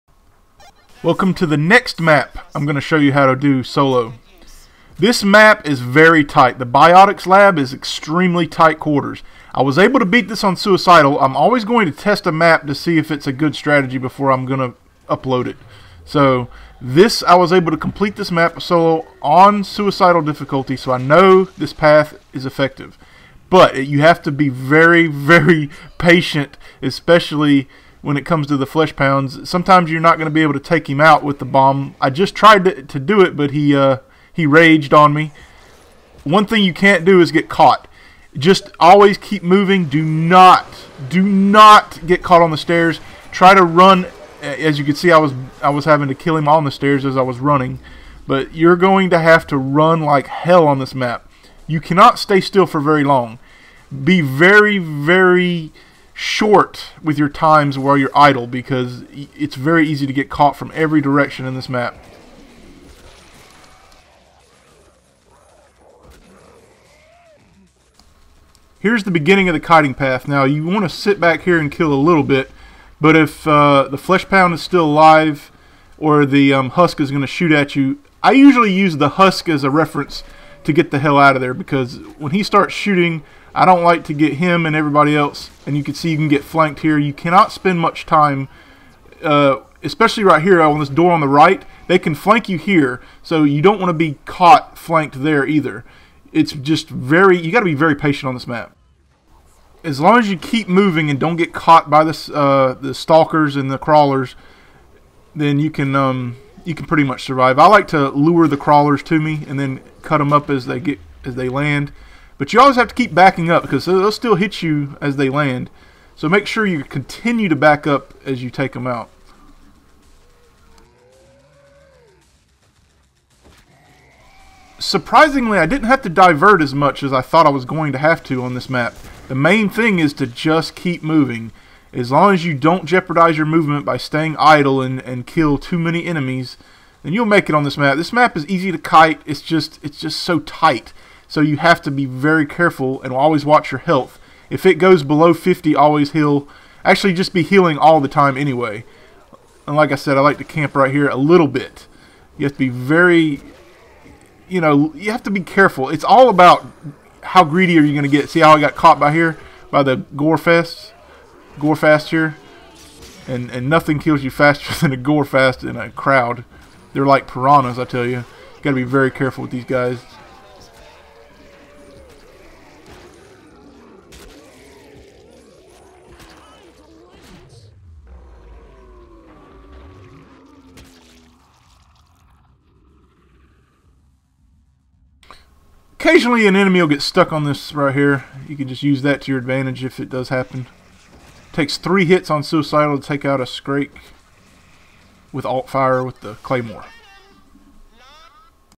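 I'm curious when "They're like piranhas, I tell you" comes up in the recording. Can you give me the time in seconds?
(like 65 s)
166 s.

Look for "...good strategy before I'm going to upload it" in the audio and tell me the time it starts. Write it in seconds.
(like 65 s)
13 s.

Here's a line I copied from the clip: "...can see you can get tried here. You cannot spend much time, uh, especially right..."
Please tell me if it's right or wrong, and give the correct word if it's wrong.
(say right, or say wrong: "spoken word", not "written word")
wrong: "flanked", not "tried".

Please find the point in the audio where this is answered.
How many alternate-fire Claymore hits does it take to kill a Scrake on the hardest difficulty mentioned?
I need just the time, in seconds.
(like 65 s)
191 s.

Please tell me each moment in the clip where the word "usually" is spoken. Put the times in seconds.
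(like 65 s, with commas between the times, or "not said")
78 s.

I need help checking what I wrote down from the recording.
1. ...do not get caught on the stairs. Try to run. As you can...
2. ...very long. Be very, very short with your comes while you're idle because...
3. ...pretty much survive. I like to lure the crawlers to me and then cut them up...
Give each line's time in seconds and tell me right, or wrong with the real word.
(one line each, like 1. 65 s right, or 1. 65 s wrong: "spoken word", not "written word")
1. 41 s right
2. 52 s wrong: "times", not "comes"
3. 106 s right.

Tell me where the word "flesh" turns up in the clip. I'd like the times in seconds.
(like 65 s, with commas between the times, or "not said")
28 s, 73 s.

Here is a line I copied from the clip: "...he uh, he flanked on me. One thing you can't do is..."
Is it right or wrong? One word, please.
wrong.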